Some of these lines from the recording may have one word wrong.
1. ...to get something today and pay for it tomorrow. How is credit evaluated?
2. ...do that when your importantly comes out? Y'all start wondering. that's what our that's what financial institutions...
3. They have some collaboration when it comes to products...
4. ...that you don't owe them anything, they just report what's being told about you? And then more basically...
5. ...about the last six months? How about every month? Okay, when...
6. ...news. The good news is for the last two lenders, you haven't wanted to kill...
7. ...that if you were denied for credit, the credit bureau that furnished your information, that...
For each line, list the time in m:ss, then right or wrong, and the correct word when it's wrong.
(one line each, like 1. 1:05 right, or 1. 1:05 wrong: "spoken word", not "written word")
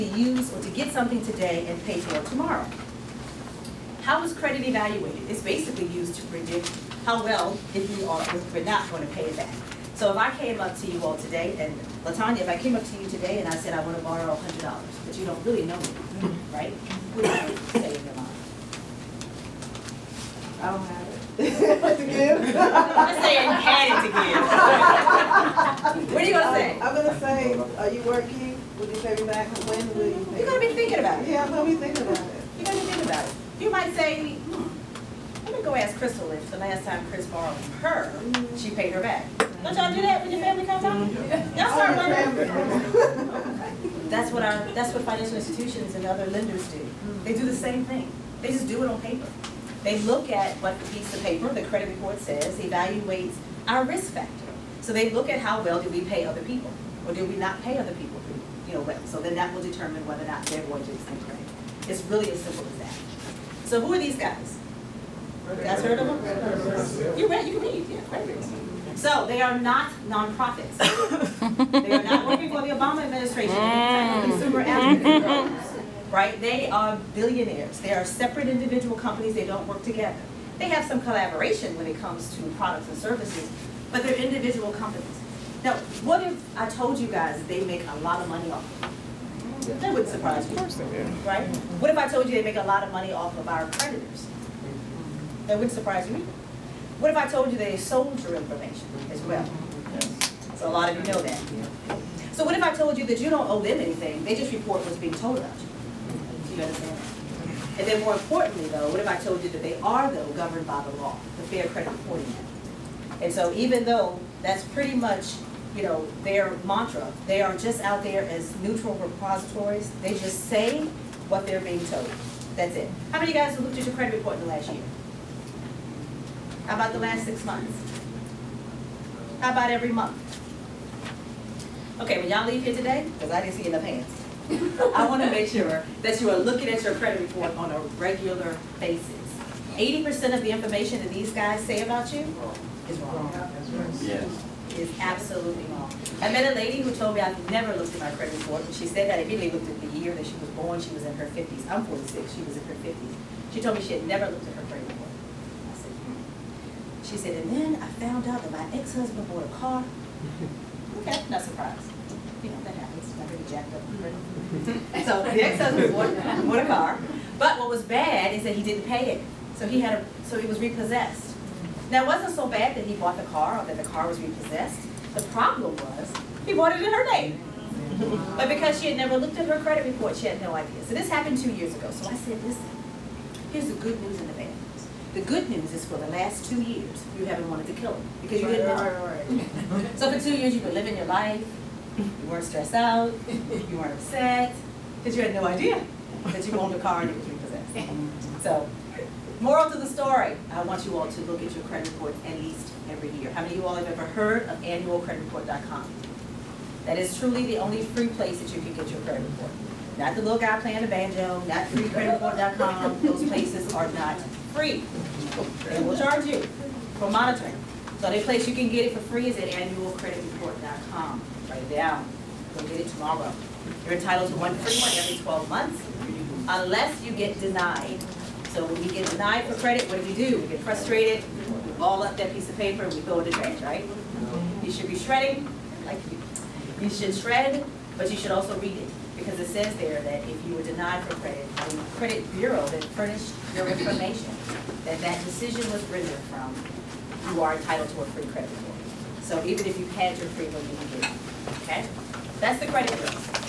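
1. 0:00 right
2. 0:39 wrong: "family", not "importantly"
3. 1:20 right
4. 1:43 wrong: "importantly", not "basically"
5. 2:06 right
6. 3:04 wrong: "years", not "lenders"
7. 4:00 right.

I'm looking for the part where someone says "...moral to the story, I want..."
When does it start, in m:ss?
3:19.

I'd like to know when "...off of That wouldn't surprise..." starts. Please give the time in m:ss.
1:28.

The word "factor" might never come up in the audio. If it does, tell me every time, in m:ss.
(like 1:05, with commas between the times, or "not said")
0:54.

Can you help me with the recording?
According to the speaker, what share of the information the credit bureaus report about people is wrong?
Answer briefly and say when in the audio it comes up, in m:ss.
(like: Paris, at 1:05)
80%, at 2:19.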